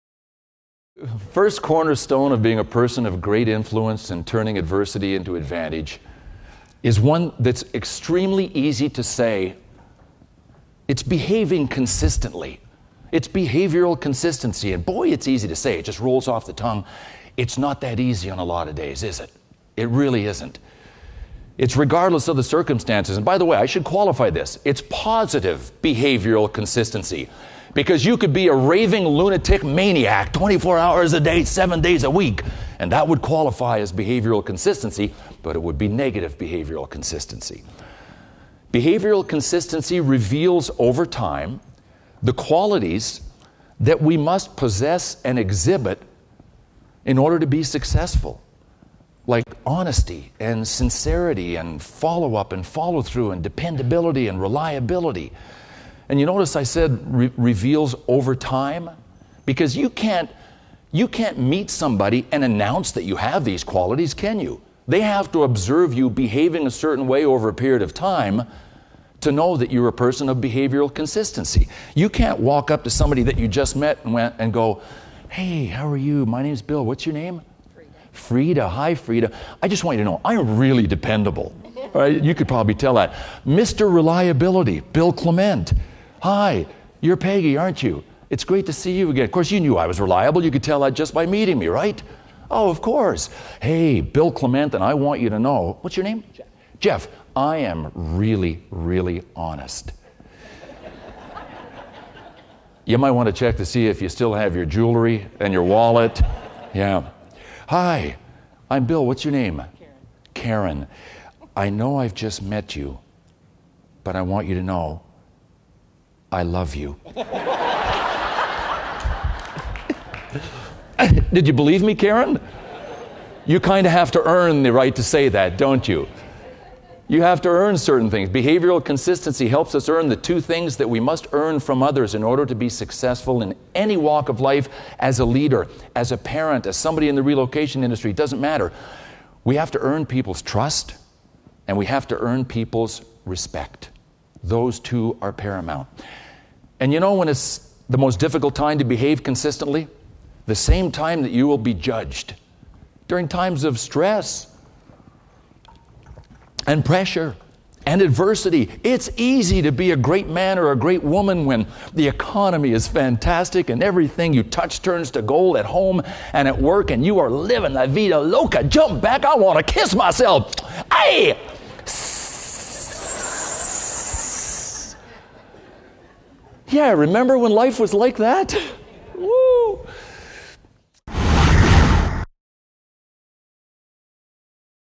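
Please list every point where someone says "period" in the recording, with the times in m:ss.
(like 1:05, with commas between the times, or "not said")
1:07.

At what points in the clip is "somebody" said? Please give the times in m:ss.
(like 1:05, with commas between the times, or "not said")
1:01, 1:12, 2:16.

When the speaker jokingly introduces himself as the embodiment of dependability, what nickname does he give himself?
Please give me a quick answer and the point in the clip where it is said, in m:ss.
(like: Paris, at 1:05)
Mr. Reliability, at 1:23.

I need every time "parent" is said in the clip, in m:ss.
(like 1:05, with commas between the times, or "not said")
2:16.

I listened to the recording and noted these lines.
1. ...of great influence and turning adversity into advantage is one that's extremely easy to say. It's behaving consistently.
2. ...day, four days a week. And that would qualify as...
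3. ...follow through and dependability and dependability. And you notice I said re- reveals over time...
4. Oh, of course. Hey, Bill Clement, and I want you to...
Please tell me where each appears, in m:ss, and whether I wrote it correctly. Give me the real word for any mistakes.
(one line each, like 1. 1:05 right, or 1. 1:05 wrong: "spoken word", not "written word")
1. 0:03 right
2. 0:31 wrong: "seven", not "four"
3. 0:52 wrong: "reliability", not "dependability"
4. 1:32 right.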